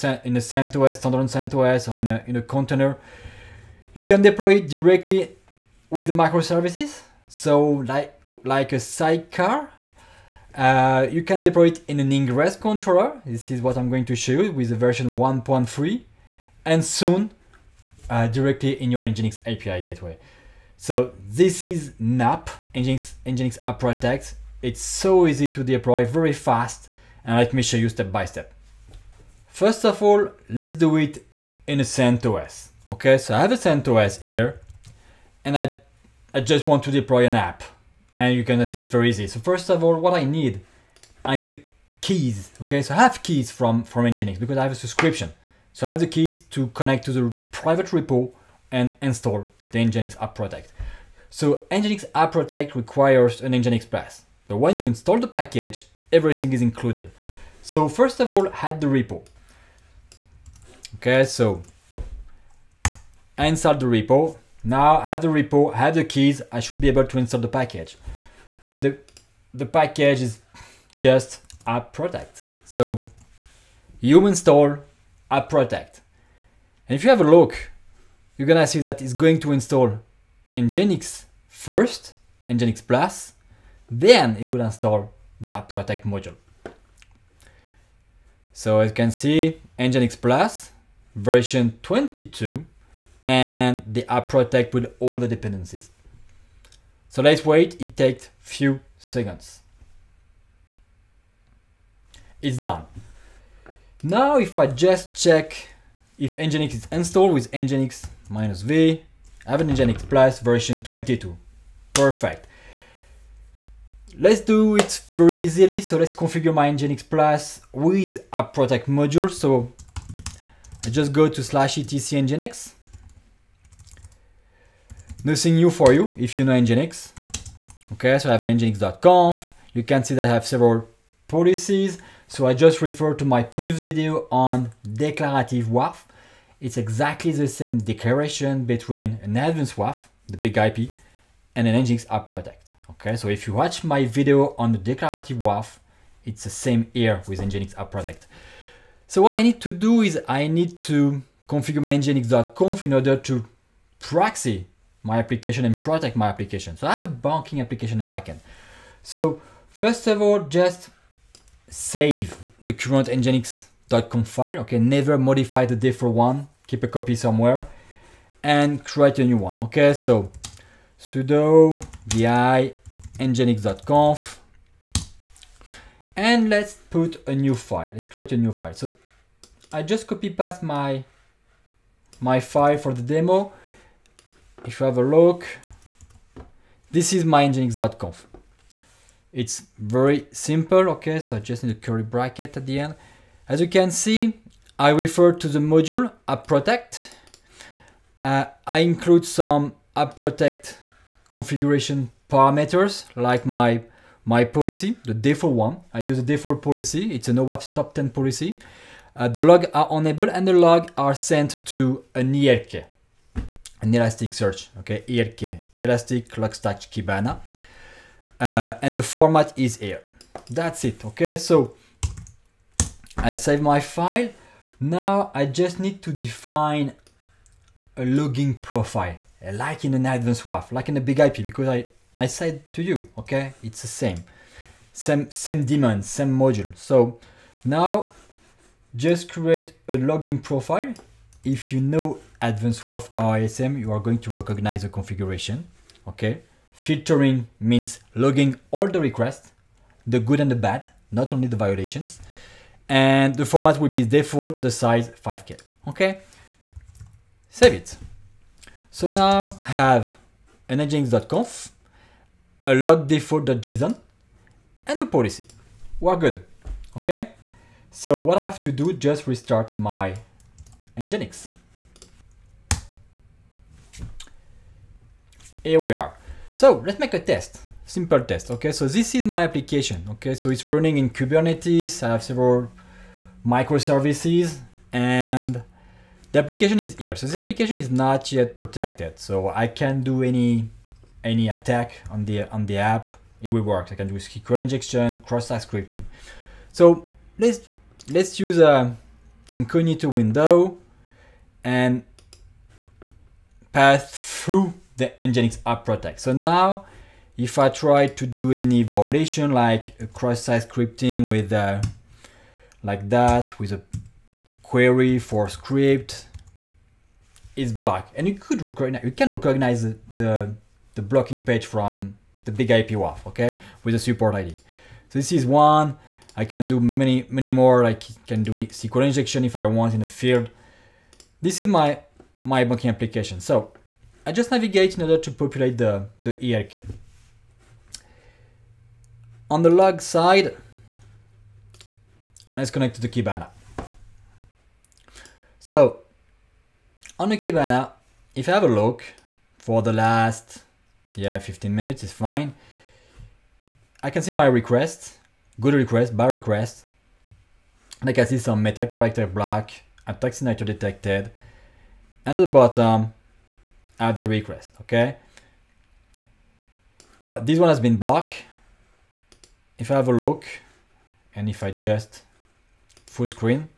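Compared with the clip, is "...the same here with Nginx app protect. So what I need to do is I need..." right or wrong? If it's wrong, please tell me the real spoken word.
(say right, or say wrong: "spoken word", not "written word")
right.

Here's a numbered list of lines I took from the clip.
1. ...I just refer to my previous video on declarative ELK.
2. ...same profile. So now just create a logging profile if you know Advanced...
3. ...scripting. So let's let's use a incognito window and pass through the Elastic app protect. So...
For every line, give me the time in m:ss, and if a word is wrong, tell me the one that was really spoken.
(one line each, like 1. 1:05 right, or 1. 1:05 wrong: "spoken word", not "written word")
1. 2:12 wrong: "WAF", not "ELK"
2. 3:56 wrong: "module", not "profile"
3. 4:55 wrong: "Nginx", not "Elastic".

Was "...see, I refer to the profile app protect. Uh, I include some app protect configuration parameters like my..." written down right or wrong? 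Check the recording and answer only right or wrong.
wrong.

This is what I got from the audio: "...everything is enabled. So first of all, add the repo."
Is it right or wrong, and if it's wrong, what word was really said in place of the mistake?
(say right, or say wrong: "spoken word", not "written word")
wrong: "included", not "enabled".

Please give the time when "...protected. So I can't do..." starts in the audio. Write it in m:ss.
4:48.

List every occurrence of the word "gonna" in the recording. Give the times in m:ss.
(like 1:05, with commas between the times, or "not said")
0:38, 1:18.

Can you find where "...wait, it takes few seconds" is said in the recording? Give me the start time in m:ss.
1:37.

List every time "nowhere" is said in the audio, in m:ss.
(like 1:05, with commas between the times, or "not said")
not said.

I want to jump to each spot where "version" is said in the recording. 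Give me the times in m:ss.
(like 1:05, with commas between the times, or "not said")
0:14, 1:31, 1:50.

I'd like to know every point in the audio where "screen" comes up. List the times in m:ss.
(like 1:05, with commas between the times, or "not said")
6:13.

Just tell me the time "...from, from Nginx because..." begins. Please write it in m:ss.
0:43.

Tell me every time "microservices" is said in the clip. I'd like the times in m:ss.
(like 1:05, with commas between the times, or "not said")
0:06, 4:43.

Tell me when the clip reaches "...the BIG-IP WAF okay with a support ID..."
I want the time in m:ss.
5:22.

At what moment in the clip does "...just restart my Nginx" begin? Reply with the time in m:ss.
4:28.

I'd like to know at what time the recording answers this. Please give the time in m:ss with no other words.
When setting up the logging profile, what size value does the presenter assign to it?
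4:15.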